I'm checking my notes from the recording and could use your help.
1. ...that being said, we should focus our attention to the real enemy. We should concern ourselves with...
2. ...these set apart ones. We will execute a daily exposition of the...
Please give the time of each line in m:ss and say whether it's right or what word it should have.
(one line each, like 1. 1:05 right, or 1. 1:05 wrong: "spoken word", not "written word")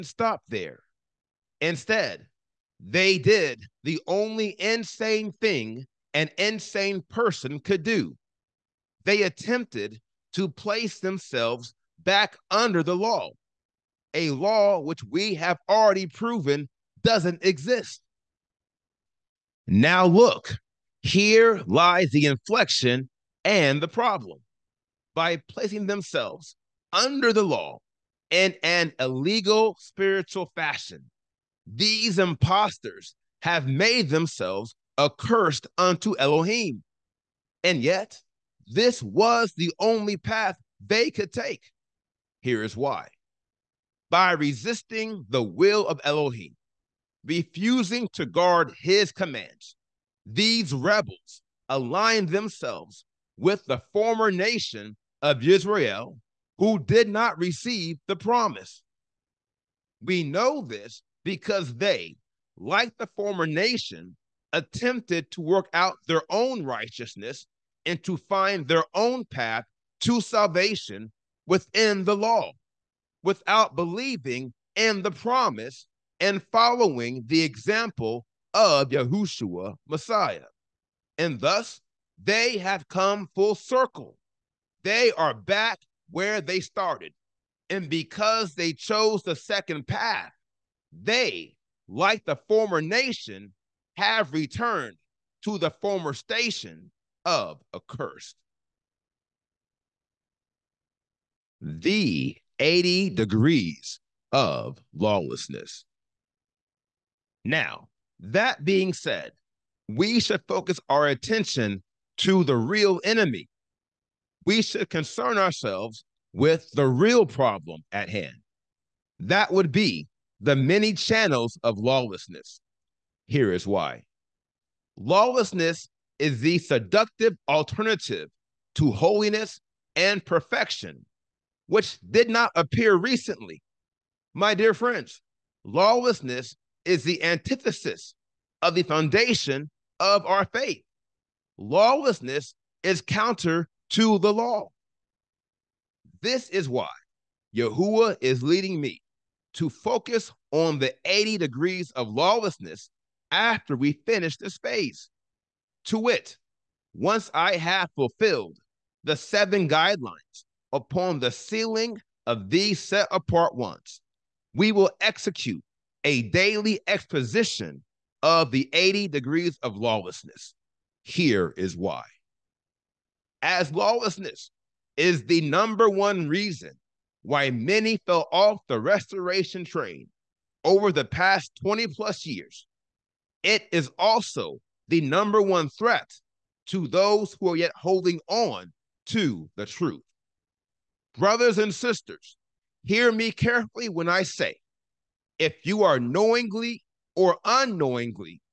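1. 1:48 right
2. 2:42 right.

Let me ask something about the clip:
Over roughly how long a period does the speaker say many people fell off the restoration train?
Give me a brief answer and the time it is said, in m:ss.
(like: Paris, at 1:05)
20 plus years, at 3:01.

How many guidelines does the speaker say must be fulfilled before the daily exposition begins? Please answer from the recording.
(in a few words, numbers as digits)
7.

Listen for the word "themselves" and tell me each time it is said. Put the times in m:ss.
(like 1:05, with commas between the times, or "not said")
0:10, 0:25, 0:34, 0:52.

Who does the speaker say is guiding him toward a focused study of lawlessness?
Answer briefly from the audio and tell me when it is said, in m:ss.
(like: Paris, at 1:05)
Yahuwah, at 2:27.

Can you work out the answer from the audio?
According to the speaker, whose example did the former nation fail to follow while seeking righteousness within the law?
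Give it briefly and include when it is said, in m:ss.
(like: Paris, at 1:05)
Yahushua Messiah, at 1:18.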